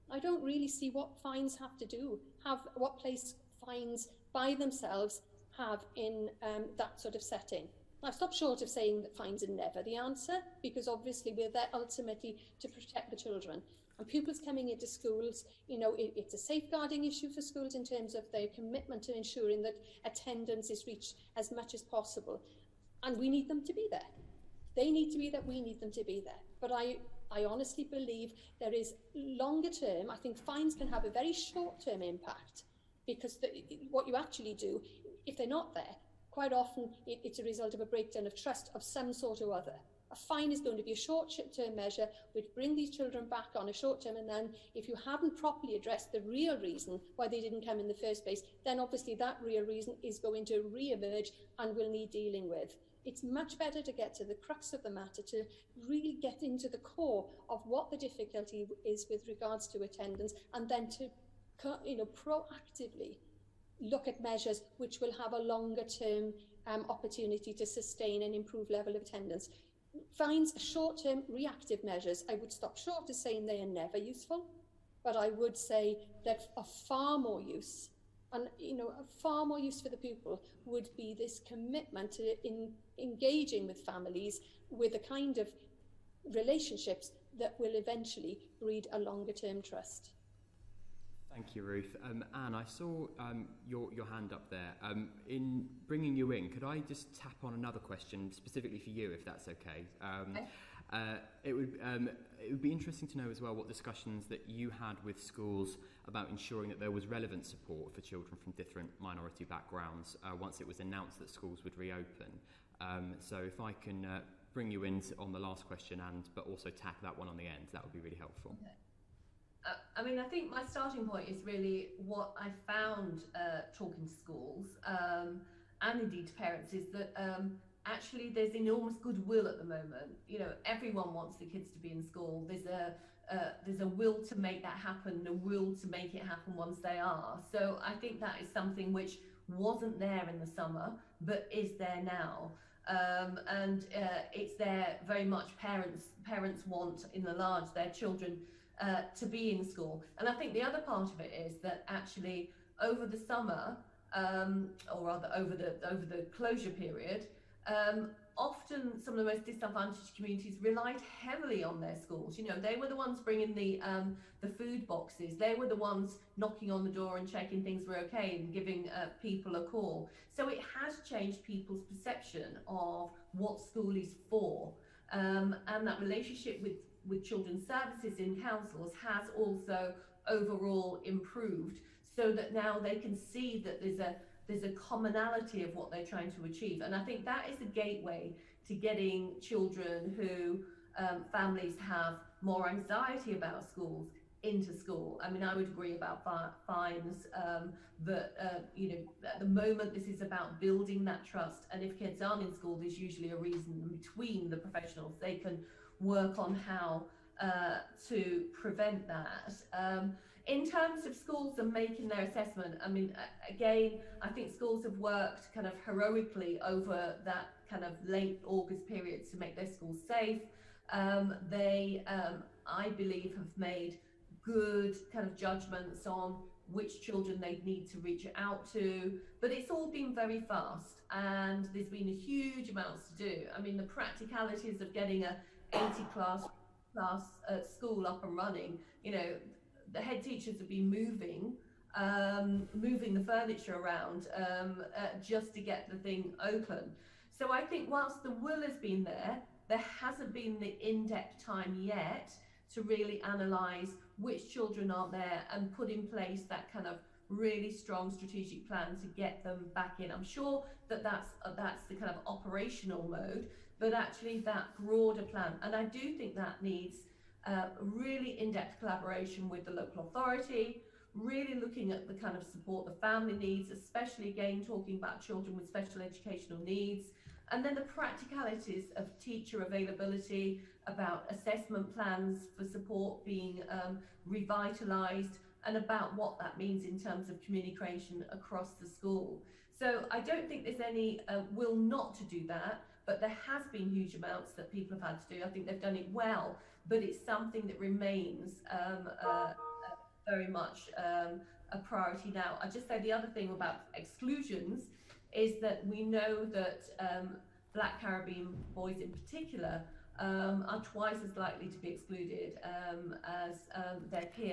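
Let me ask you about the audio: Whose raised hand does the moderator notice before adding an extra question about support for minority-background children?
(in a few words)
Anne.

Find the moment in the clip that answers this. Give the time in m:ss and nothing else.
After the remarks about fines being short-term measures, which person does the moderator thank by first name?
1:31.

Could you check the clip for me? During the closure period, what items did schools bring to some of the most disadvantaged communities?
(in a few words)
food boxes.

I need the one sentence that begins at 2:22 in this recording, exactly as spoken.
Um, and uh, it's there very much.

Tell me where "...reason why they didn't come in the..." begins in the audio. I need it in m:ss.
0:46.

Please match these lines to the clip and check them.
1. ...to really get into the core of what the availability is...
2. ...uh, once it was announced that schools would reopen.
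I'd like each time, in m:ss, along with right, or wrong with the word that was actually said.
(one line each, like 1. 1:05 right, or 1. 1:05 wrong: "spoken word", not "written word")
1. 0:55 wrong: "difficulty", not "availability"
2. 1:50 right.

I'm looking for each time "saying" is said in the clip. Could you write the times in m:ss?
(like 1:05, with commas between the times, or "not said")
0:08, 1:13.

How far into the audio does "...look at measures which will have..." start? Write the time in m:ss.
1:03.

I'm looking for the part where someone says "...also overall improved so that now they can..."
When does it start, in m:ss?
2:59.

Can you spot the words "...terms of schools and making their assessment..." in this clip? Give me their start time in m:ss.
3:30.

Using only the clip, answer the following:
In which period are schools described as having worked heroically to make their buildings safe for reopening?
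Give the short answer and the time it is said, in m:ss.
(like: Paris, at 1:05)
late August, at 3:38.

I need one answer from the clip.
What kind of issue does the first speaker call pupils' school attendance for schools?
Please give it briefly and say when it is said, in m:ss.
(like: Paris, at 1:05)
safeguarding, at 0:16.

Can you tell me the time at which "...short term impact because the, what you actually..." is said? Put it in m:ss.
0:31.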